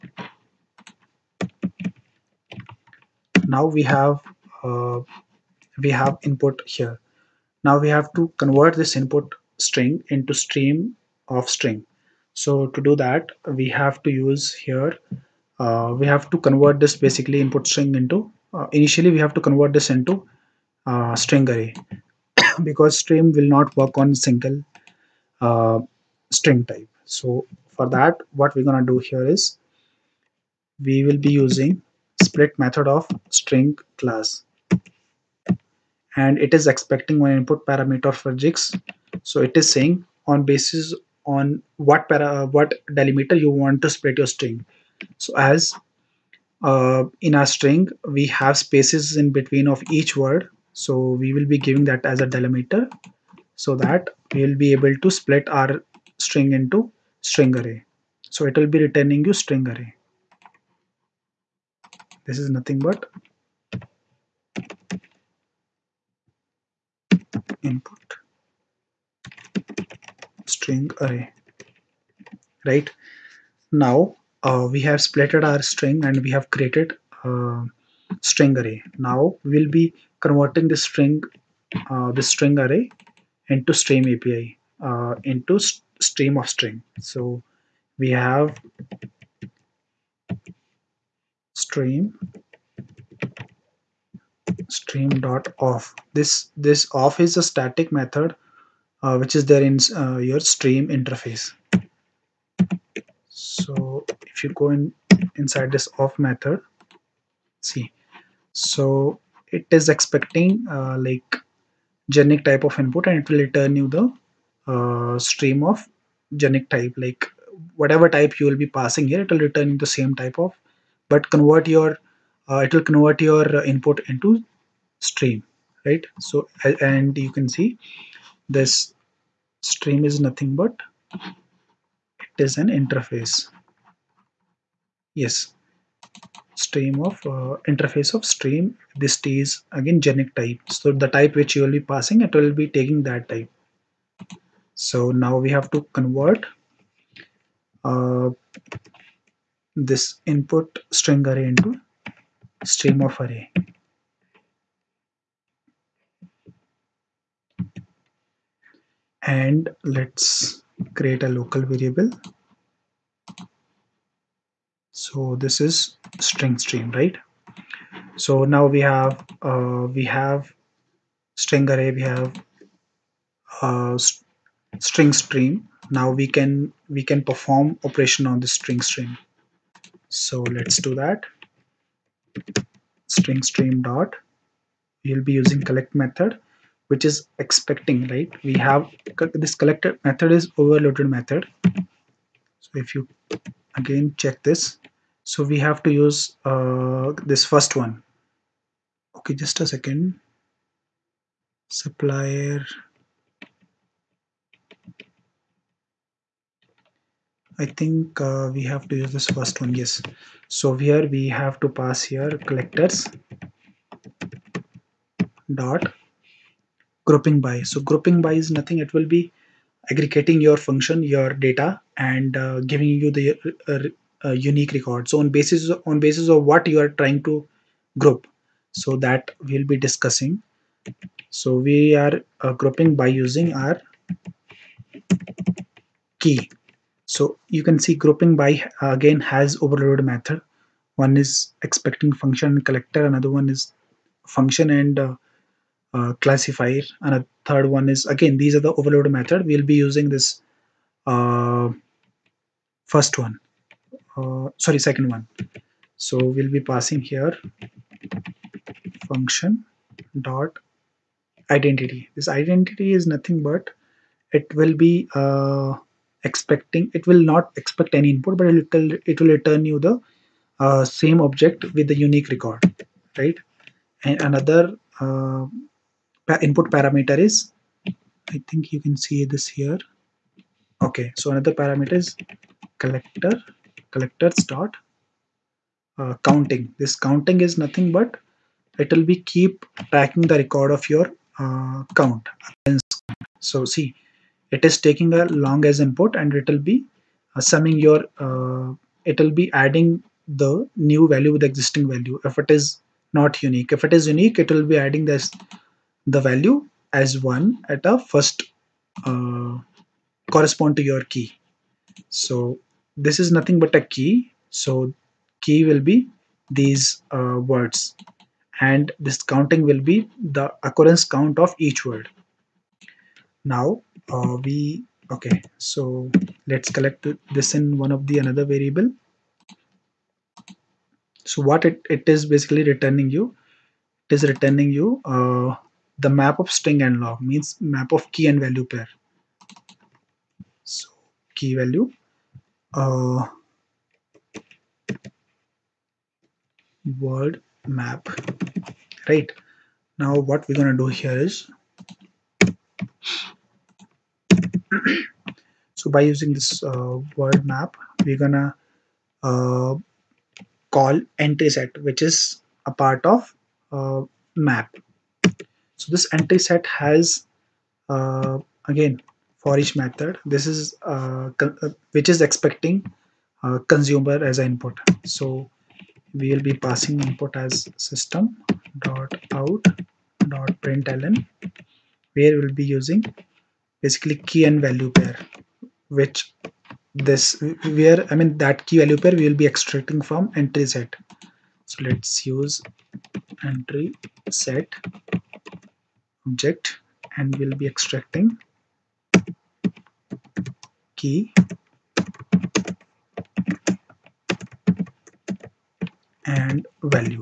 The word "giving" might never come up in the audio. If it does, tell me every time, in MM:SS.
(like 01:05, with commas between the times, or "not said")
00:51, 03:42.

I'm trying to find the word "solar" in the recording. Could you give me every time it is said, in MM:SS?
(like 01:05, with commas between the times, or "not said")
not said.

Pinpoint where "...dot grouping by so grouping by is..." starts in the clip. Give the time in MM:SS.
03:35.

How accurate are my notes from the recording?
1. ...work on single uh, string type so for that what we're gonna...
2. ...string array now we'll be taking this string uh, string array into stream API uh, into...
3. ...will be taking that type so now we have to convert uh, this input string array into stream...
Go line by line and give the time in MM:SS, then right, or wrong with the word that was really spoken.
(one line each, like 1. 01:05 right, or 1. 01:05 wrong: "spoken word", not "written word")
1. 00:23 right
2. 01:18 wrong: "converting", not "taking"
3. 02:22 right.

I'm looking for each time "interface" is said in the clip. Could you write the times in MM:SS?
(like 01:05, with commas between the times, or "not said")
01:40, 02:12, 02:17.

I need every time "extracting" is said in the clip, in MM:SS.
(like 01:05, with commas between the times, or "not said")
06:29, 06:37.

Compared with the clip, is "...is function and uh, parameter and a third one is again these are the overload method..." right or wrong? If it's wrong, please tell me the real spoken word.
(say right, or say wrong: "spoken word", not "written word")
wrong: "classifier", not "parameter".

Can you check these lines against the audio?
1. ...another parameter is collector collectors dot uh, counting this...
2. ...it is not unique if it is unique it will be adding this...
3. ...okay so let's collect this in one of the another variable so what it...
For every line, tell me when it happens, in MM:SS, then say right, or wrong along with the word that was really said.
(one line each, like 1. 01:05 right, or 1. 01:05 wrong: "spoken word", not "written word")
1. 04:41 right
2. 05:02 right
3. 05:25 right.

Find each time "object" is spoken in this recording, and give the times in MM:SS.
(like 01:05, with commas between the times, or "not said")
04:31, 06:36.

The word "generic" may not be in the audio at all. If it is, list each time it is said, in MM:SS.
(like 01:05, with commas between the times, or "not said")
01:52, 01:56, 02:20.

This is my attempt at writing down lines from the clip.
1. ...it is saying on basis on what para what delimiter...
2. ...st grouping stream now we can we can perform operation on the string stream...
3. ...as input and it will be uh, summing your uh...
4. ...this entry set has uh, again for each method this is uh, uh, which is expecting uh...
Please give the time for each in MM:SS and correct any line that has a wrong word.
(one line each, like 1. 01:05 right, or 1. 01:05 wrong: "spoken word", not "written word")
1. 00:39 right
2. 02:54 wrong: "string", not "grouping"
3. 04:55 right
4. 06:05 right.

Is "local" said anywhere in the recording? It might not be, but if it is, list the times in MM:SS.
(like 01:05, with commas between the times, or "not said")
02:41.